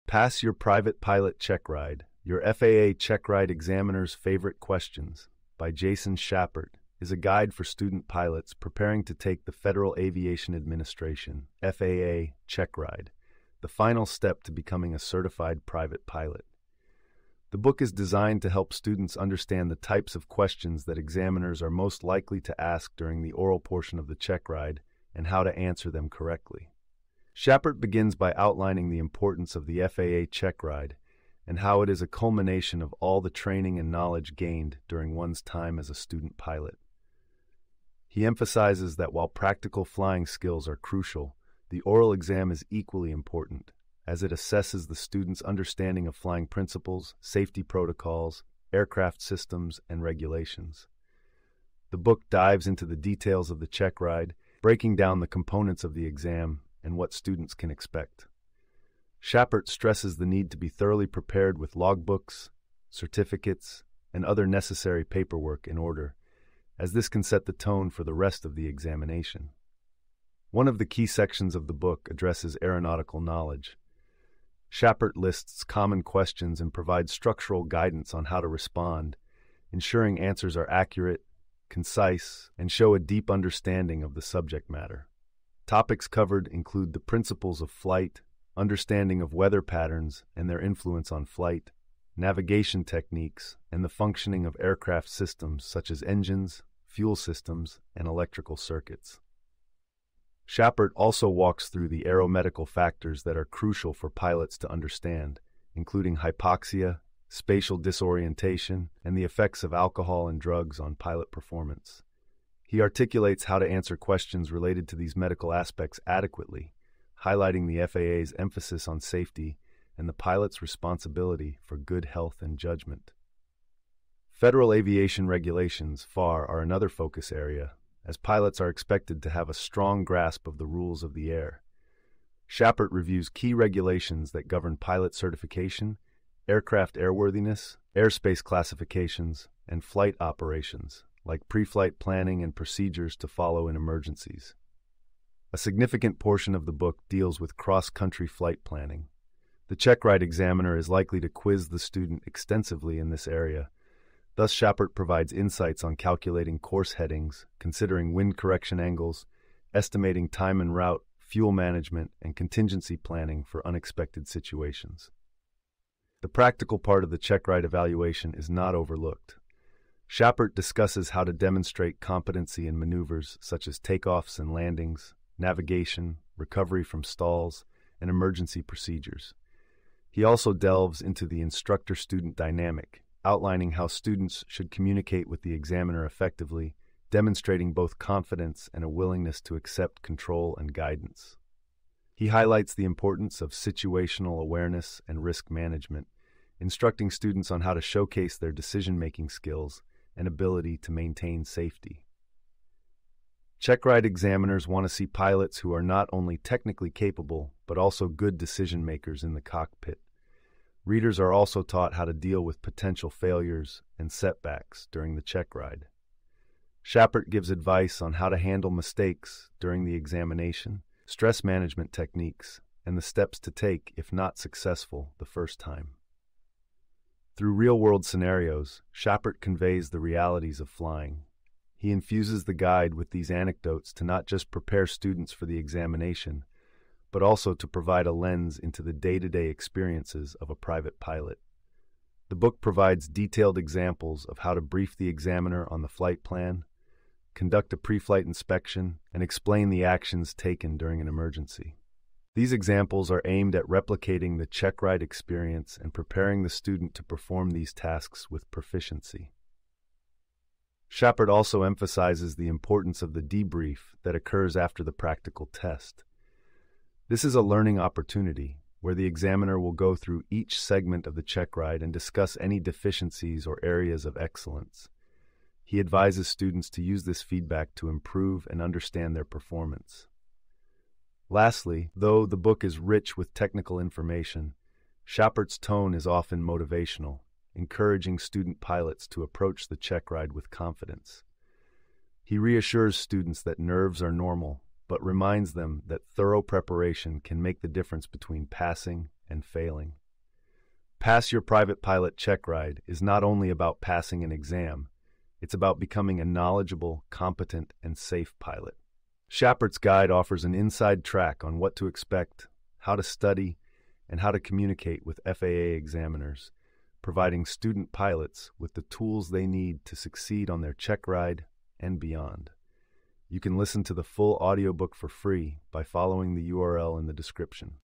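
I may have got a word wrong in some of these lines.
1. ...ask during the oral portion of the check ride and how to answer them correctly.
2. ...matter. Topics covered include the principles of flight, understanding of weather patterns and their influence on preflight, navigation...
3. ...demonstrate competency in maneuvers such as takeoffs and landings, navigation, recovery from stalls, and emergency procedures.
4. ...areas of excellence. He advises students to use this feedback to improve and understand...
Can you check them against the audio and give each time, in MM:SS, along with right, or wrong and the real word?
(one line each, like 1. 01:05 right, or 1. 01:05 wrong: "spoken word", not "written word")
1. 00:22 right
2. 01:24 wrong: "flight", not "preflight"
3. 02:51 right
4. 04:33 right.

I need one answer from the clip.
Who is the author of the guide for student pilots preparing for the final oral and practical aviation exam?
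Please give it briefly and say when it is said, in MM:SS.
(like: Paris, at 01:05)
Jason Schappert, at 00:05.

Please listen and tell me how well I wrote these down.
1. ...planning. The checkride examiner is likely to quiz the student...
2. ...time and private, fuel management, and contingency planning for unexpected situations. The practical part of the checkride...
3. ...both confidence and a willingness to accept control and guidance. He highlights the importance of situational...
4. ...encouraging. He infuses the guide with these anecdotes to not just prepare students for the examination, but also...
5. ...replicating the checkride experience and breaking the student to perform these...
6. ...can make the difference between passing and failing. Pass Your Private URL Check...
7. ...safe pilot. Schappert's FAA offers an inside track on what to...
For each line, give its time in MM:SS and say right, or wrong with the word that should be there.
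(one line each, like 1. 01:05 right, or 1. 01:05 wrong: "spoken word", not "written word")
1. 02:28 right
2. 02:40 wrong: "route", not "private"
3. 03:07 right
4. 03:50 wrong: "flying", not "encouraging"
5. 04:13 wrong: "preparing", not "breaking"
6. 04:57 wrong: "Pilot", not "URL"
7. 05:07 wrong: "Guide", not "FAA".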